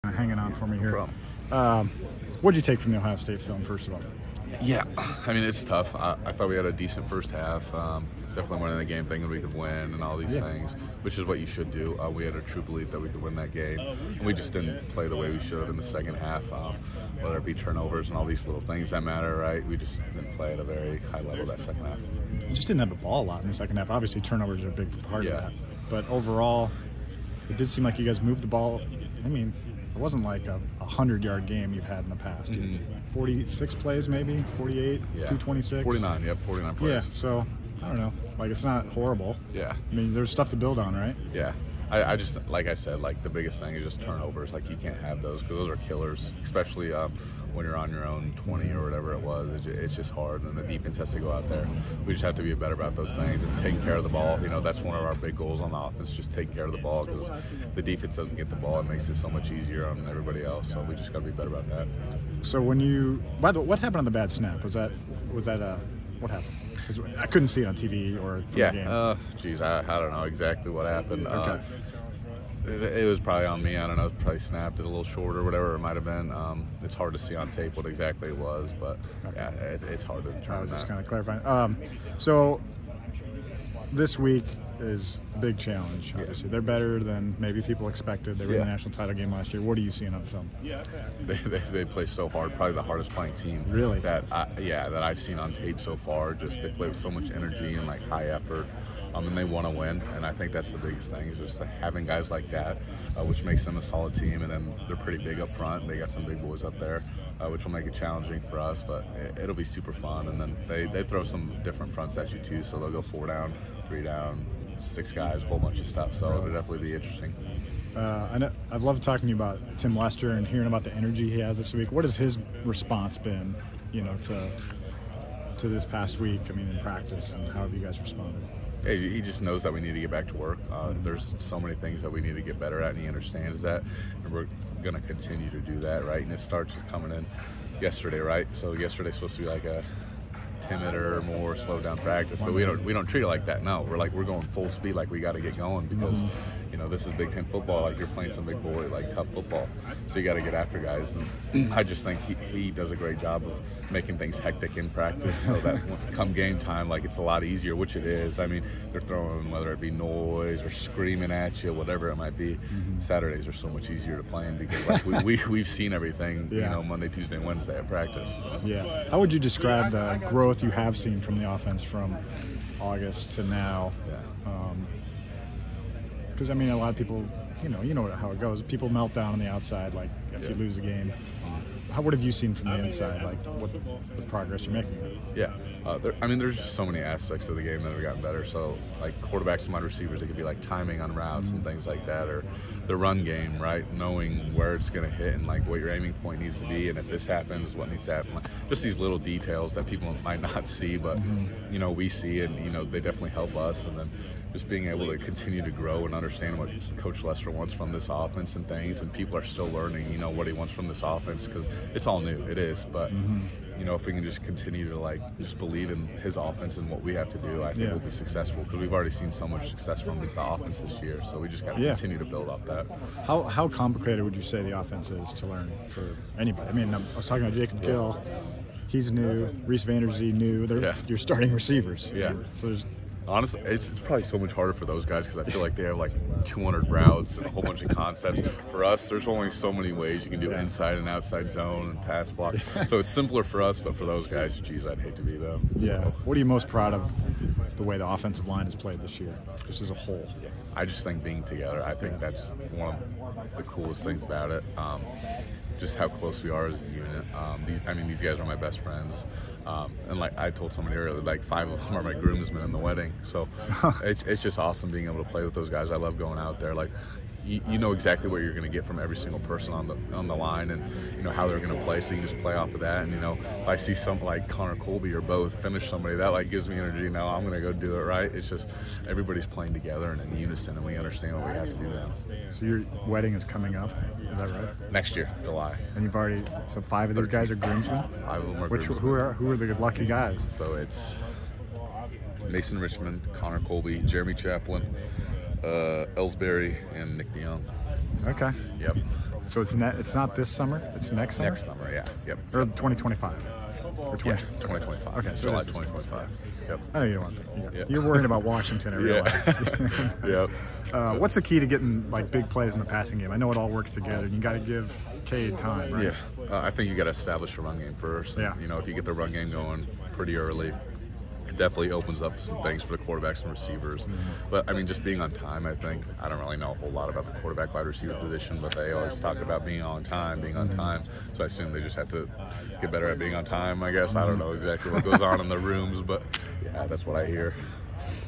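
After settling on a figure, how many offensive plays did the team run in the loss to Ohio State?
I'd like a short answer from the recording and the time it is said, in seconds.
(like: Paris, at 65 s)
49, at 35 s.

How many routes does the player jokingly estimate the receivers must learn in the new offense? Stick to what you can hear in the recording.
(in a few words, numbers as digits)
200.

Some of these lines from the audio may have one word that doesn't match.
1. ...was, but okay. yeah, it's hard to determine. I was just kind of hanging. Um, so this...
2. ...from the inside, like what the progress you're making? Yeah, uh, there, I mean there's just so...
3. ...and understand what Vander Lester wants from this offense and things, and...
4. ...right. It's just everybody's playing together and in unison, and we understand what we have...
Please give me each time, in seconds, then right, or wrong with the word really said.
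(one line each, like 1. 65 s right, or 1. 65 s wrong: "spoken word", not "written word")
1. 78 s wrong: "clarifying", not "hanging"
2. 182 s right
3. 206 s wrong: "Coach", not "Vander"
4. 278 s right.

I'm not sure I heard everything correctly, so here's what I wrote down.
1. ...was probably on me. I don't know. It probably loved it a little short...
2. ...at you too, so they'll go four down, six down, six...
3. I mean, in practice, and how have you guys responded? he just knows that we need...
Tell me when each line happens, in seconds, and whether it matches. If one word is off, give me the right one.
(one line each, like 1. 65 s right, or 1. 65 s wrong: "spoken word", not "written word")
1. 73 s wrong: "snapped", not "loved"
2. 112 s wrong: "three", not "six"
3. 126 s right.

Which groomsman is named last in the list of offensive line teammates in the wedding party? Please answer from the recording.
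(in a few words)
Nick DeJong.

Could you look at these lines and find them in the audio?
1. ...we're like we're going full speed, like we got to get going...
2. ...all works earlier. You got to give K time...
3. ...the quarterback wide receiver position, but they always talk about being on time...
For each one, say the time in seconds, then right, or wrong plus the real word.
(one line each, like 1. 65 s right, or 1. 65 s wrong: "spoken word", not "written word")
1. 143 s right
2. 313 s wrong: "together", not "earlier"
3. 327 s right.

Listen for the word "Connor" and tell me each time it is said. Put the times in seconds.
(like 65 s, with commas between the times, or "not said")
274 s, 293 s.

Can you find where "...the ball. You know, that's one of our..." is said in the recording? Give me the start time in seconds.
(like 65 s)
54 s.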